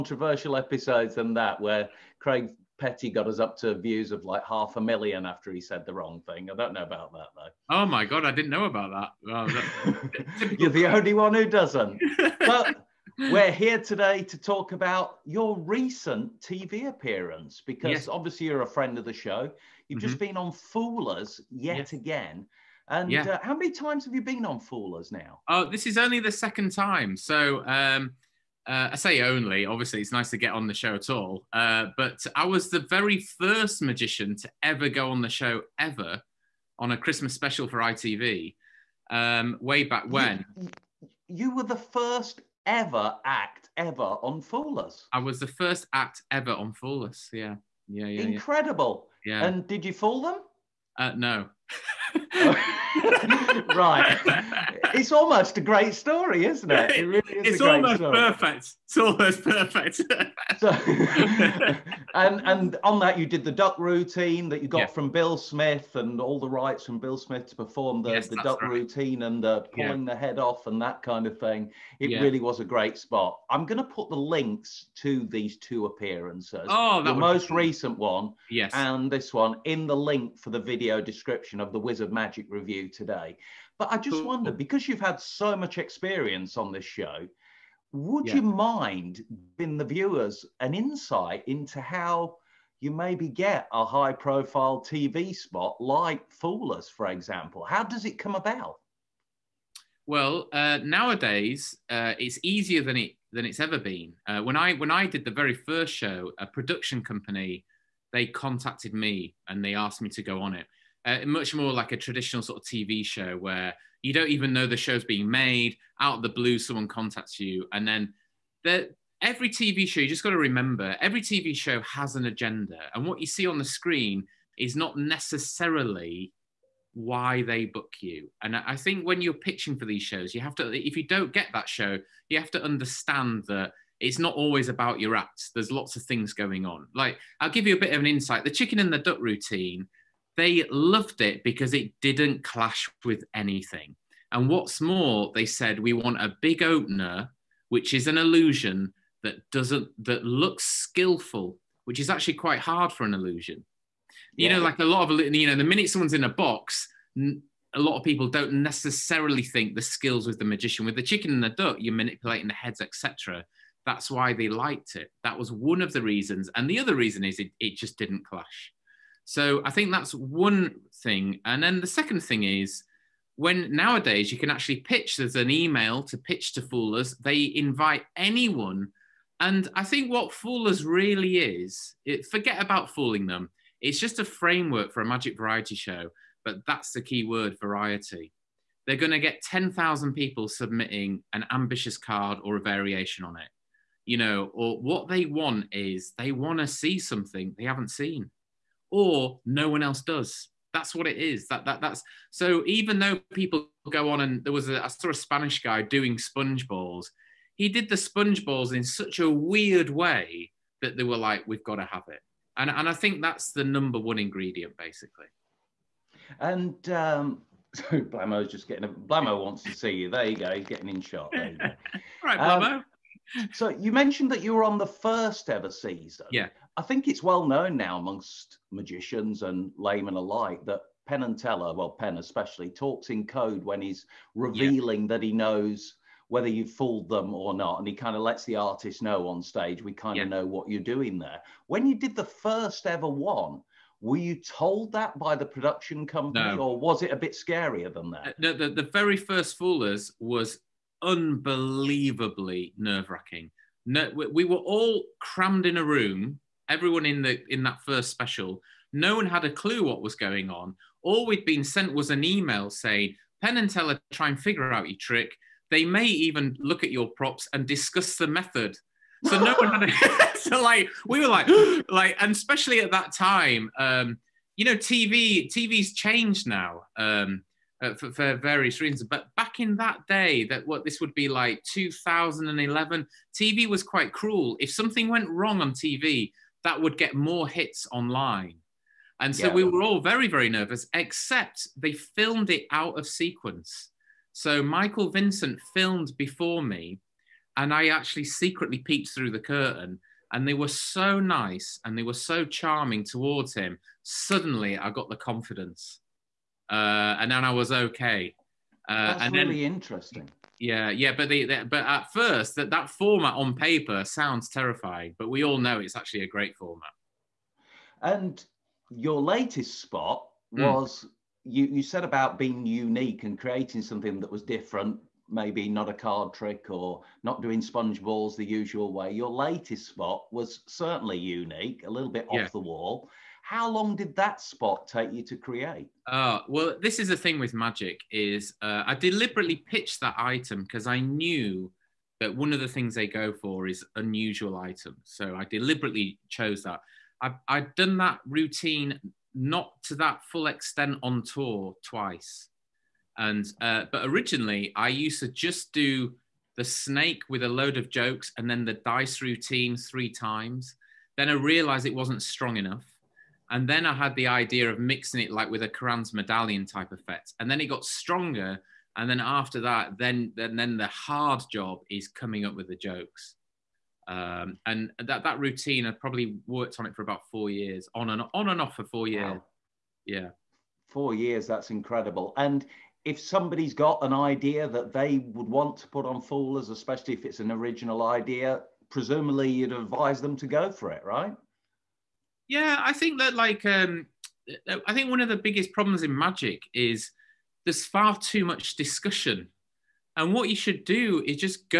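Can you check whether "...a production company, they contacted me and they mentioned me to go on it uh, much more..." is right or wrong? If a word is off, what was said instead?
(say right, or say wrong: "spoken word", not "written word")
wrong: "asked", not "mentioned".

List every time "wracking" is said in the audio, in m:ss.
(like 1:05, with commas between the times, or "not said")
4:13.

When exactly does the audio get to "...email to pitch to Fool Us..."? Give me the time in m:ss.
2:55.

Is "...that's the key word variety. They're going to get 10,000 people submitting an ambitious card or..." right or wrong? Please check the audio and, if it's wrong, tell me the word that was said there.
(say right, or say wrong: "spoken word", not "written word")
right.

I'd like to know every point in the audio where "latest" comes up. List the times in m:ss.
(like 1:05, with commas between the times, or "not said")
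5:19, 5:29.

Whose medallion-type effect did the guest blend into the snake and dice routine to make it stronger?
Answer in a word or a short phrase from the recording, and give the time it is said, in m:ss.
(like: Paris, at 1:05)
Karan's, at 6:05.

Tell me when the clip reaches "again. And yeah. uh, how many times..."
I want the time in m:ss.
0:21.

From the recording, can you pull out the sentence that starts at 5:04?
Suddenly, I got the confidence uh, and then I was okay.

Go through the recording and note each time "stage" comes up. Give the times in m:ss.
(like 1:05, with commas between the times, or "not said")
3:59.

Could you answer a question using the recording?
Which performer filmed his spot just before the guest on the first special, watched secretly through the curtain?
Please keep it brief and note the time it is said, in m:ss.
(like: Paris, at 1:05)
Michael Vincent, at 4:54.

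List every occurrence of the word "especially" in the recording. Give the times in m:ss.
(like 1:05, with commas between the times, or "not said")
3:52, 4:32, 6:26.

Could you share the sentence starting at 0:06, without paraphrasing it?
I don't know about that though.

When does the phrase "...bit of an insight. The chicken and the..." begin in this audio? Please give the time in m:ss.
2:17.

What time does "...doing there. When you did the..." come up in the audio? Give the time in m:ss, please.
4:00.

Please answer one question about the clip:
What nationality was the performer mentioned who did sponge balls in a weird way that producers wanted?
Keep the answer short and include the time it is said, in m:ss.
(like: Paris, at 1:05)
Spanish, at 3:25.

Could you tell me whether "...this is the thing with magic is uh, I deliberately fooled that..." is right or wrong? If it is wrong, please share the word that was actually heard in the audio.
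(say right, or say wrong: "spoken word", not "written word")
wrong: "pitched", not "fooled".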